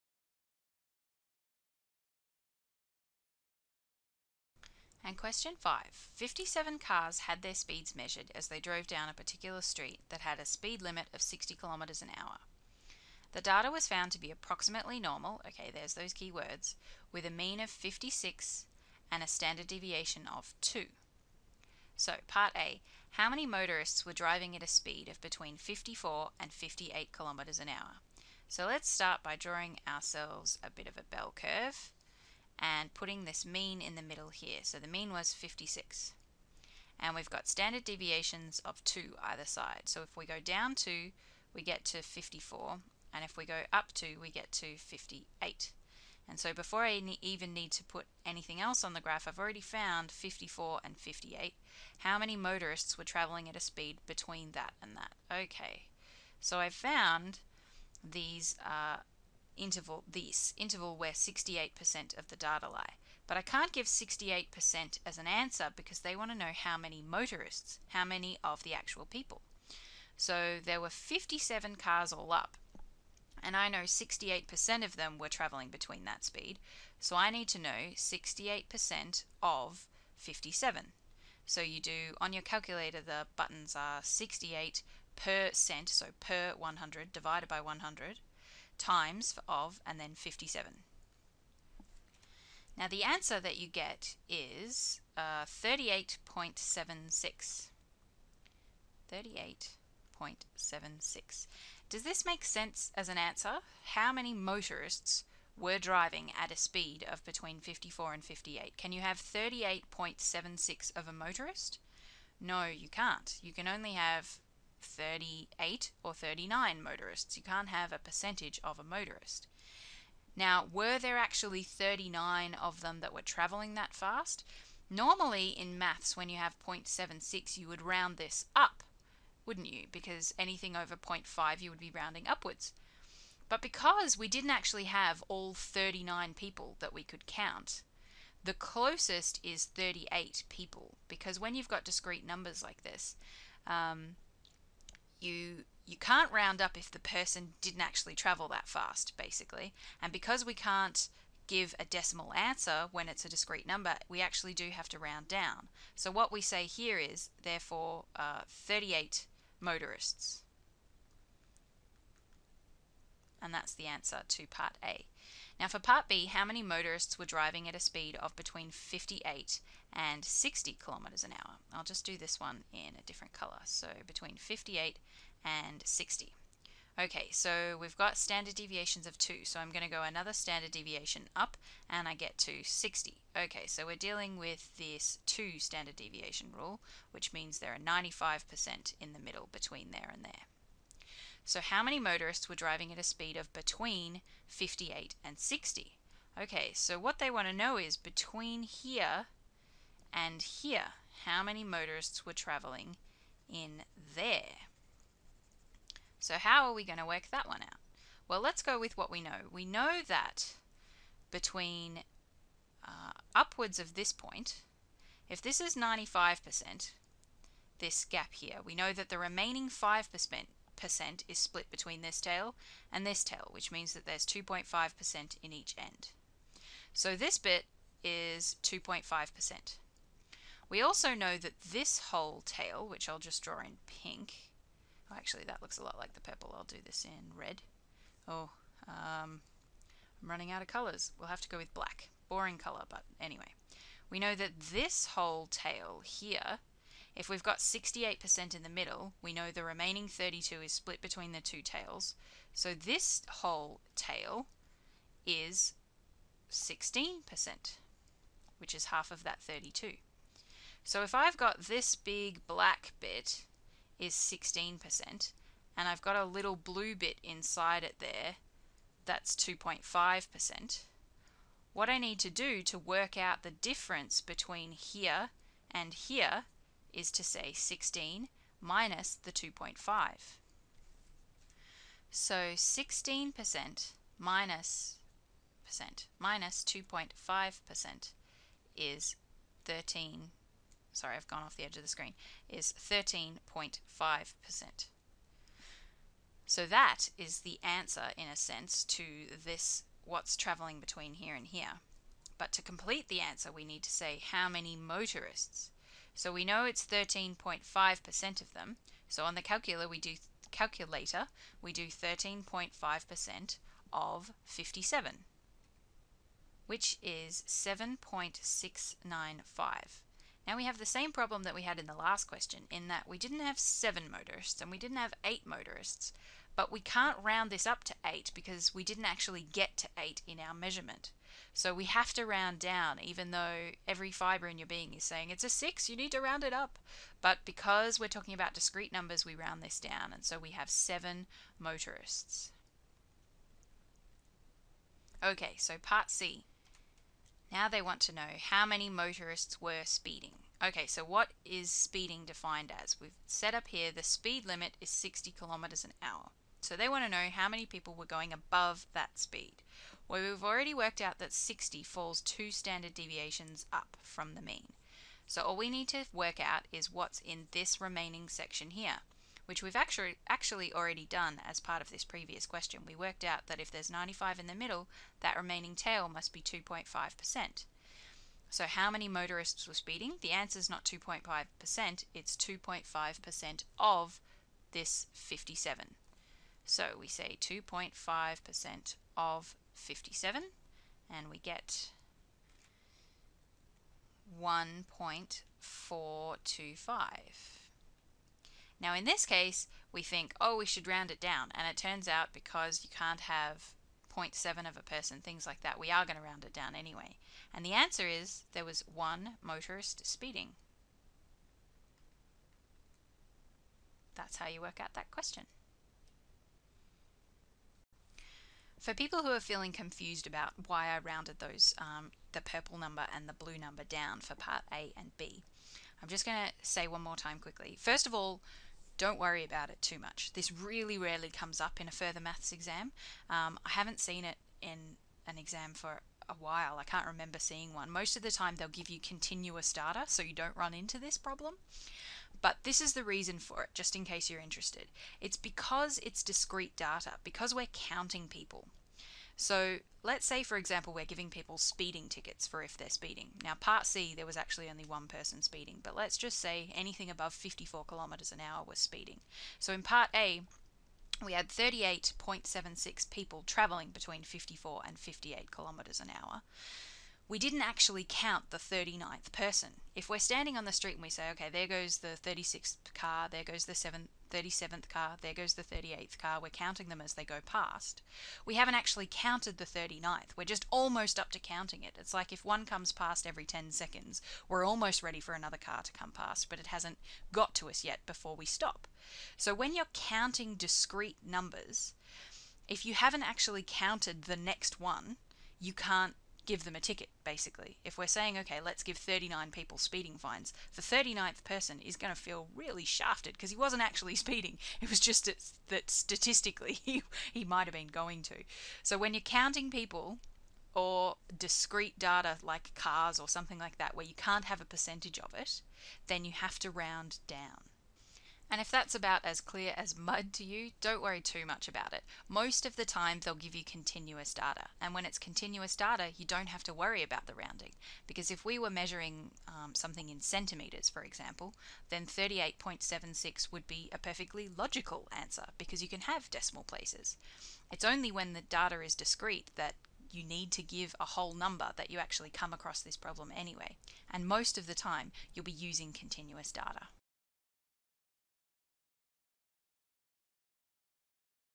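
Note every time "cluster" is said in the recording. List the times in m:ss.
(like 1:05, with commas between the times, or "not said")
not said.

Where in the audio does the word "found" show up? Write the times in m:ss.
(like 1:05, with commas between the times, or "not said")
0:13, 0:49, 0:56.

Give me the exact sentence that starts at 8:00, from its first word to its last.
We're just almost up to counting it.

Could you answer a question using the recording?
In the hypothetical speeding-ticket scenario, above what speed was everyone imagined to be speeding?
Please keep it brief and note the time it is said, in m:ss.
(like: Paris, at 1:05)
54 km/h, at 7:37.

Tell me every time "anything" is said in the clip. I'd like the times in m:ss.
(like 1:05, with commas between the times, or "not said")
0:48, 2:10, 7:36.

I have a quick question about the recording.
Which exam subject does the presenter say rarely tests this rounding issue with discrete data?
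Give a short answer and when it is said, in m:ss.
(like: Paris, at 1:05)
Further maths, at 7:11.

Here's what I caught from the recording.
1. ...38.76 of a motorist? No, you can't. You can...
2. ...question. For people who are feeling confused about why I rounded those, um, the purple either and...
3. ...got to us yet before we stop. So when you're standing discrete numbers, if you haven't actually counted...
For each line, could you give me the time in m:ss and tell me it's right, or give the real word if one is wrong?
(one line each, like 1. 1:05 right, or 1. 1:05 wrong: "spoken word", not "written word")
1. 1:49 right
2. 6:55 wrong: "number", not "either"
3. 8:07 wrong: "counting", not "standing".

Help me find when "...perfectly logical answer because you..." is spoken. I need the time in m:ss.
8:53.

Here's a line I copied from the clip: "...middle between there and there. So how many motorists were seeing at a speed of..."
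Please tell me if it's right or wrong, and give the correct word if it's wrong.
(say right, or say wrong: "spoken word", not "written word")
wrong: "driving", not "seeing".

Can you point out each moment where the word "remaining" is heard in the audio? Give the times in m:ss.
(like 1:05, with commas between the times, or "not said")
3:39, 4:09, 6:07, 6:15.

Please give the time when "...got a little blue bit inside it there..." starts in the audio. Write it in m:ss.
4:26.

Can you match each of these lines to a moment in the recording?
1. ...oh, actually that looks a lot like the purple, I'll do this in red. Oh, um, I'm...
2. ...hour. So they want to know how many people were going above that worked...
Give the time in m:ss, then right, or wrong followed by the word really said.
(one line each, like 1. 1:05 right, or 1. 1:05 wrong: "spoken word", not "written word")
1. 3:55 right
2. 5:56 wrong: "speed", not "worked".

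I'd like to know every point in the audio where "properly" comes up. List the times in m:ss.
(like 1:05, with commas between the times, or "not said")
not said.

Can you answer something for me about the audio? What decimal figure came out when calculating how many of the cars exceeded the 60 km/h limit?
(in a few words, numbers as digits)
1.425.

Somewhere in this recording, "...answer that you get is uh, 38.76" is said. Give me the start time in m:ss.
1:33.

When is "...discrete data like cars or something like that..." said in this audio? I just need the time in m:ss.
8:31.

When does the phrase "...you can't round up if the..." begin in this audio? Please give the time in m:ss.
2:25.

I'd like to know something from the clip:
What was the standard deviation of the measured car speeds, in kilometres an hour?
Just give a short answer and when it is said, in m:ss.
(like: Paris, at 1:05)
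2, at 0:19.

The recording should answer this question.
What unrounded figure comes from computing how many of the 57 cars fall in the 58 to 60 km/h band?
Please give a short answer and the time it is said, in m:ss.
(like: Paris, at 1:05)
7.695, at 5:17.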